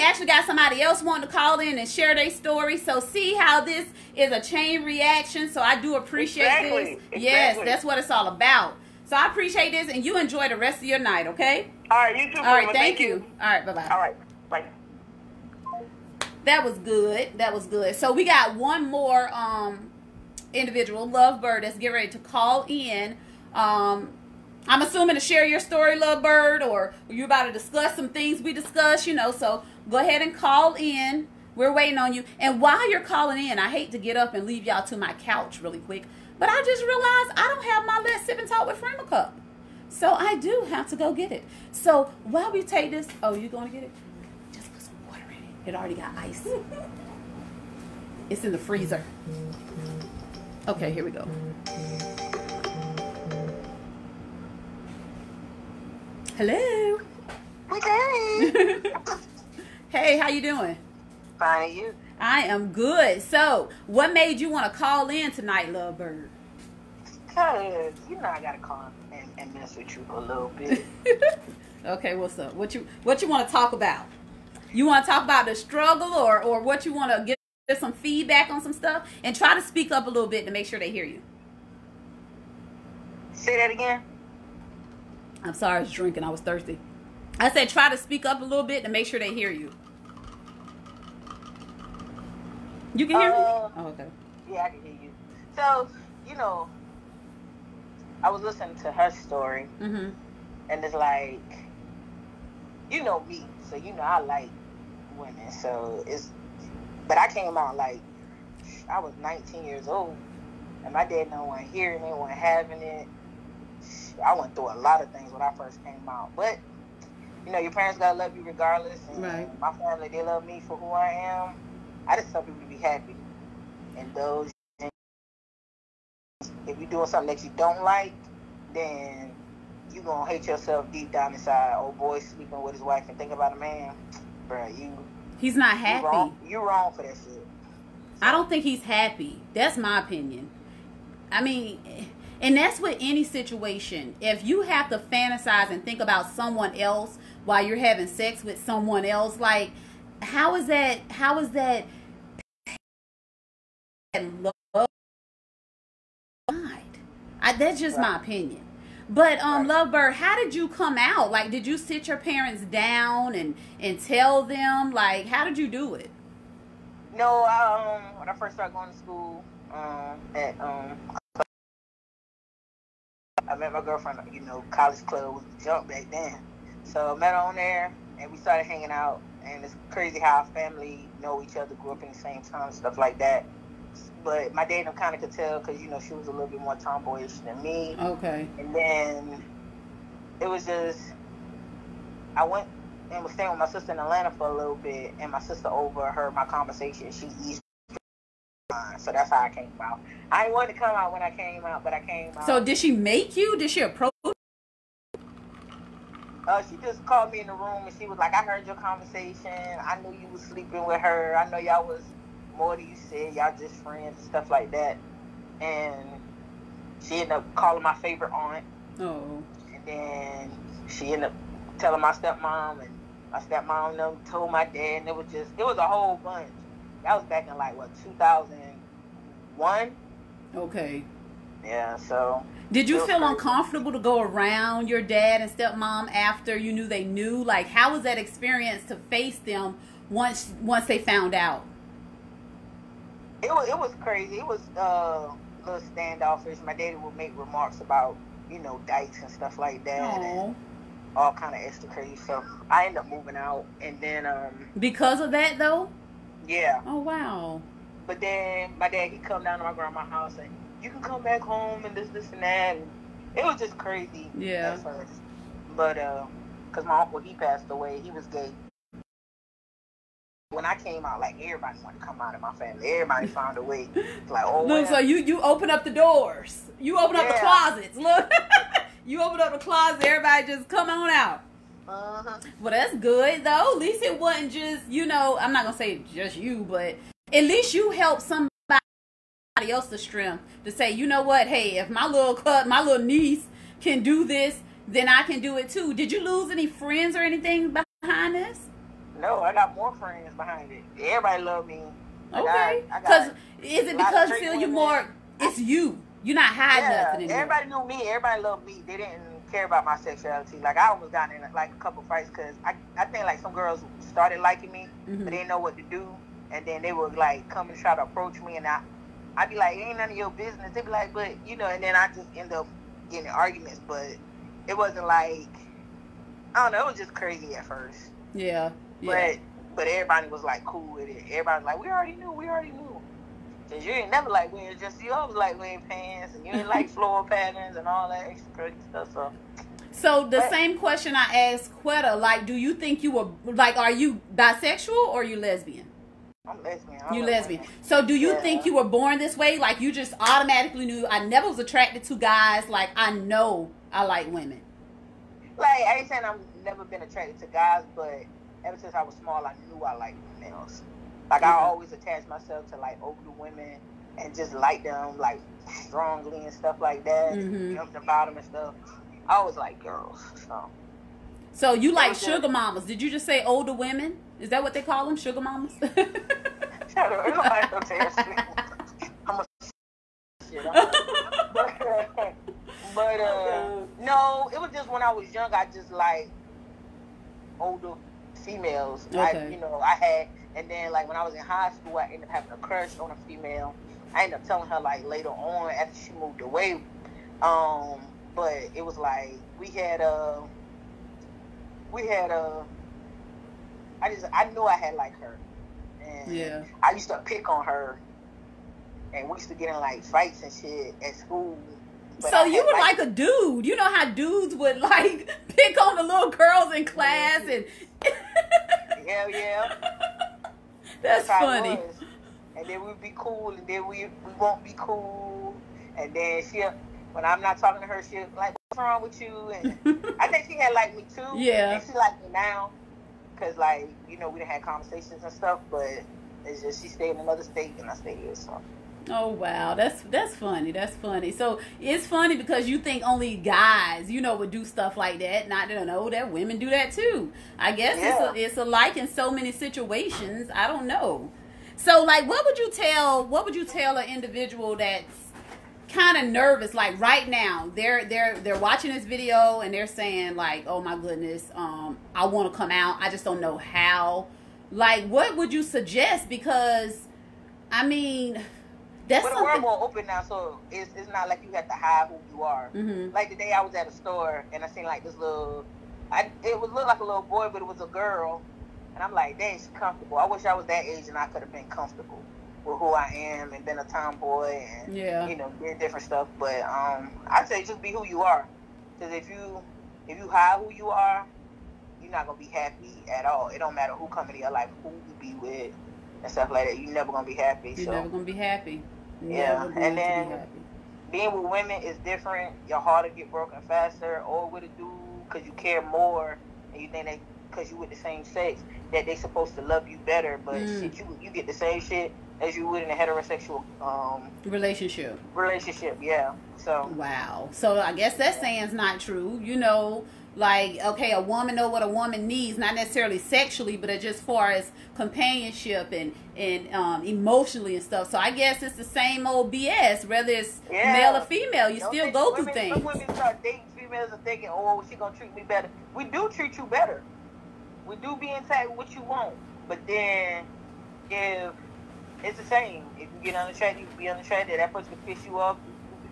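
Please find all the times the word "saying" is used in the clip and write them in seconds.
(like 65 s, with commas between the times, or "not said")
356 s, 459 s, 518 s.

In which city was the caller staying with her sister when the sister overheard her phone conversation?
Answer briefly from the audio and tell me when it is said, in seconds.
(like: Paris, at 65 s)
Atlanta, at 193 s.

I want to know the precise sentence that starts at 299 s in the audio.
No, I got more friends behind it.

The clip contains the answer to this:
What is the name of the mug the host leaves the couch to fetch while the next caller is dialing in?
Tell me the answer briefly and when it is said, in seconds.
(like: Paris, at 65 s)
Let's Sip and Talk with Frema, at 38 s.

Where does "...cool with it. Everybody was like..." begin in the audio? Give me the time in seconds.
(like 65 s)
330 s.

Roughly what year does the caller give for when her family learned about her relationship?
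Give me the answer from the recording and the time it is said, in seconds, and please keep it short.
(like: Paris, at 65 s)
2001, at 228 s.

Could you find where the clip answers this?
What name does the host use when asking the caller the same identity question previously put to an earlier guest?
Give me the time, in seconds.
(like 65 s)
341 s.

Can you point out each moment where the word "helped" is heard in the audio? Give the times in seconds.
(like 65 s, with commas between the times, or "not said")
287 s.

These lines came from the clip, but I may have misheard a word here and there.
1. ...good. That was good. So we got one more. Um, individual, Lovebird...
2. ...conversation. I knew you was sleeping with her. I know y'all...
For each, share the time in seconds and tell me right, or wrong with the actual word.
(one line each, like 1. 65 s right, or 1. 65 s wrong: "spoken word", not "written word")
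1. 16 s right
2. 208 s right.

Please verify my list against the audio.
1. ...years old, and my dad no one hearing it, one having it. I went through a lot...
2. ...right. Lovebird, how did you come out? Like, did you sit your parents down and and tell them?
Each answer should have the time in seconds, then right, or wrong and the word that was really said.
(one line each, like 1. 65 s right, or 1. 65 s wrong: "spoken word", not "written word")
1. 109 s right
2. 159 s right.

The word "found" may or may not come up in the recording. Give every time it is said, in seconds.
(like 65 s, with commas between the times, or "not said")
240 s, 273 s.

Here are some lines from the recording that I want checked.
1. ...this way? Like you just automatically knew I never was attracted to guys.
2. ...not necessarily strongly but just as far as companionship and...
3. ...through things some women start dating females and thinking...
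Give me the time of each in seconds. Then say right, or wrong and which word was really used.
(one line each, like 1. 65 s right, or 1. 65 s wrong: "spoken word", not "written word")
1. 349 s right
2. 522 s wrong: "sexually", not "strongly"
3. 532 s right.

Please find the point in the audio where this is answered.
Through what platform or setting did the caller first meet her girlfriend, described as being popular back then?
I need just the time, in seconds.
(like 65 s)
174 s.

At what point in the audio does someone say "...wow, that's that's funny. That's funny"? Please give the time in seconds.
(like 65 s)
439 s.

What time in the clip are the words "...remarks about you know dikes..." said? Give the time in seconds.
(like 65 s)
247 s.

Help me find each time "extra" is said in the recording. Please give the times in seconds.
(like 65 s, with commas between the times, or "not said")
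251 s, 338 s.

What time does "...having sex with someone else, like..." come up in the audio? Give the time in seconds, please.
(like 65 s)
147 s.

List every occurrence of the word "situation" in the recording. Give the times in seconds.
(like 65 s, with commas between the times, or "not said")
143 s, 449 s.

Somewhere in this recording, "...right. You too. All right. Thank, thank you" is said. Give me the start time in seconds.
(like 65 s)
11 s.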